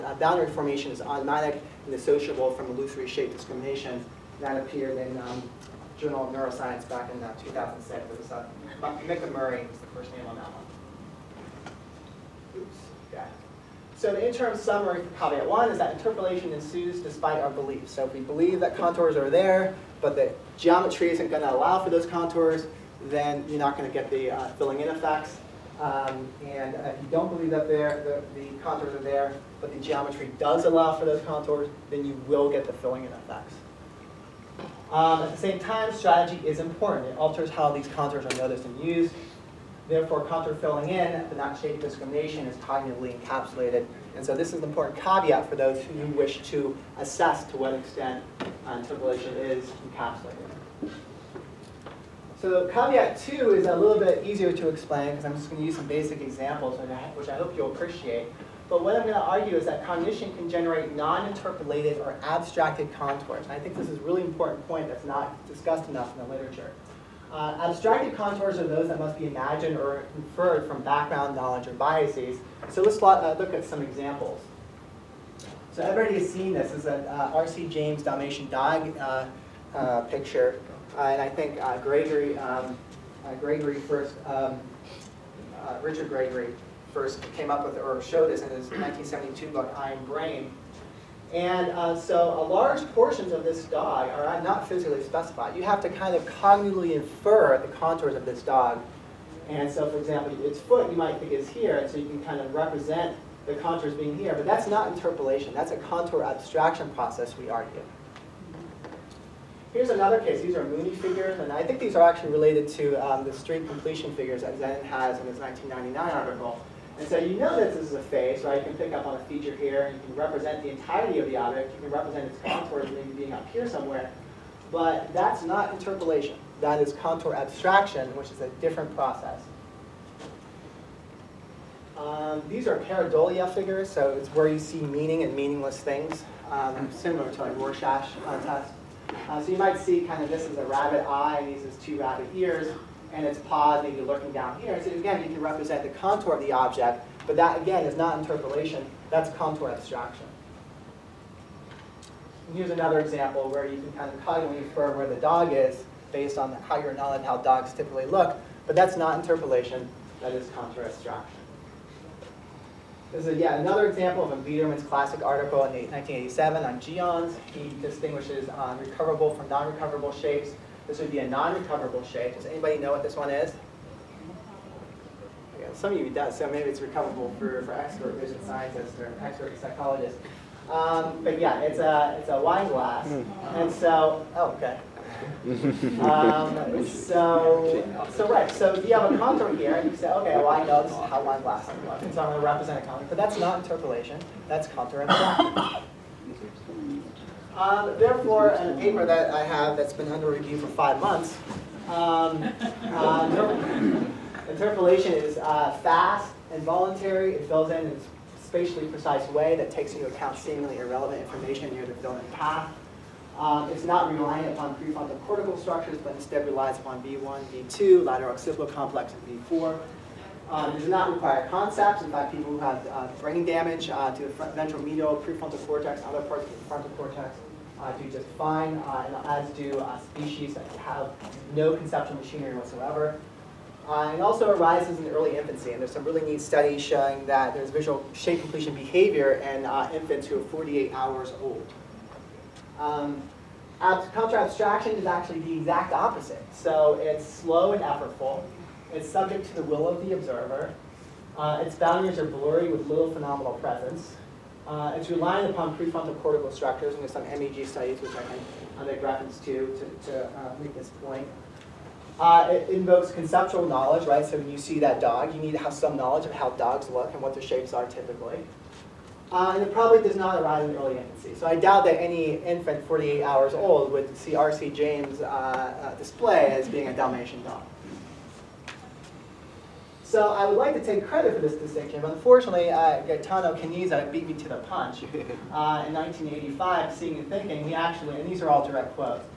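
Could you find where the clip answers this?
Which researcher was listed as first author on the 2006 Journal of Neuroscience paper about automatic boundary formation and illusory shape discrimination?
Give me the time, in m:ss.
0:09.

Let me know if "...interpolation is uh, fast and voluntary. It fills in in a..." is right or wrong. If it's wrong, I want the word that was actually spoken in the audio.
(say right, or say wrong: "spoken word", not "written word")
right.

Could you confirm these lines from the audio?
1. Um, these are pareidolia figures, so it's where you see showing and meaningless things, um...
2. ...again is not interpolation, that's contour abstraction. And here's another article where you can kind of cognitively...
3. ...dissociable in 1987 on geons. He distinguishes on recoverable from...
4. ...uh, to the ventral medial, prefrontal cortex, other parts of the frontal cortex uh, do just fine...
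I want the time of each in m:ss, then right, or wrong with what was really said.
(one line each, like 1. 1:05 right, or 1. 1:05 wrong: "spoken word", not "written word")
1. 2:11 wrong: "meaning", not "showing"
2. 2:27 wrong: "example", not "article"
3. 2:45 wrong: "article", not "dissociable"
4. 3:43 right.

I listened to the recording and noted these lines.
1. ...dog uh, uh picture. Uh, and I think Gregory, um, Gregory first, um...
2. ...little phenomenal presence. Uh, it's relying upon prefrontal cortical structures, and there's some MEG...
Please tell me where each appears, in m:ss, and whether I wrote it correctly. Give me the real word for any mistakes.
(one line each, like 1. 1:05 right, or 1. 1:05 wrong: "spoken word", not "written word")
1. 1:18 right
2. 4:12 right.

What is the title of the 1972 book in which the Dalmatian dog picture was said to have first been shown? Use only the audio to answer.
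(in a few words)
I Am Brain.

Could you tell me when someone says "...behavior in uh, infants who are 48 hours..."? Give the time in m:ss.
3:58.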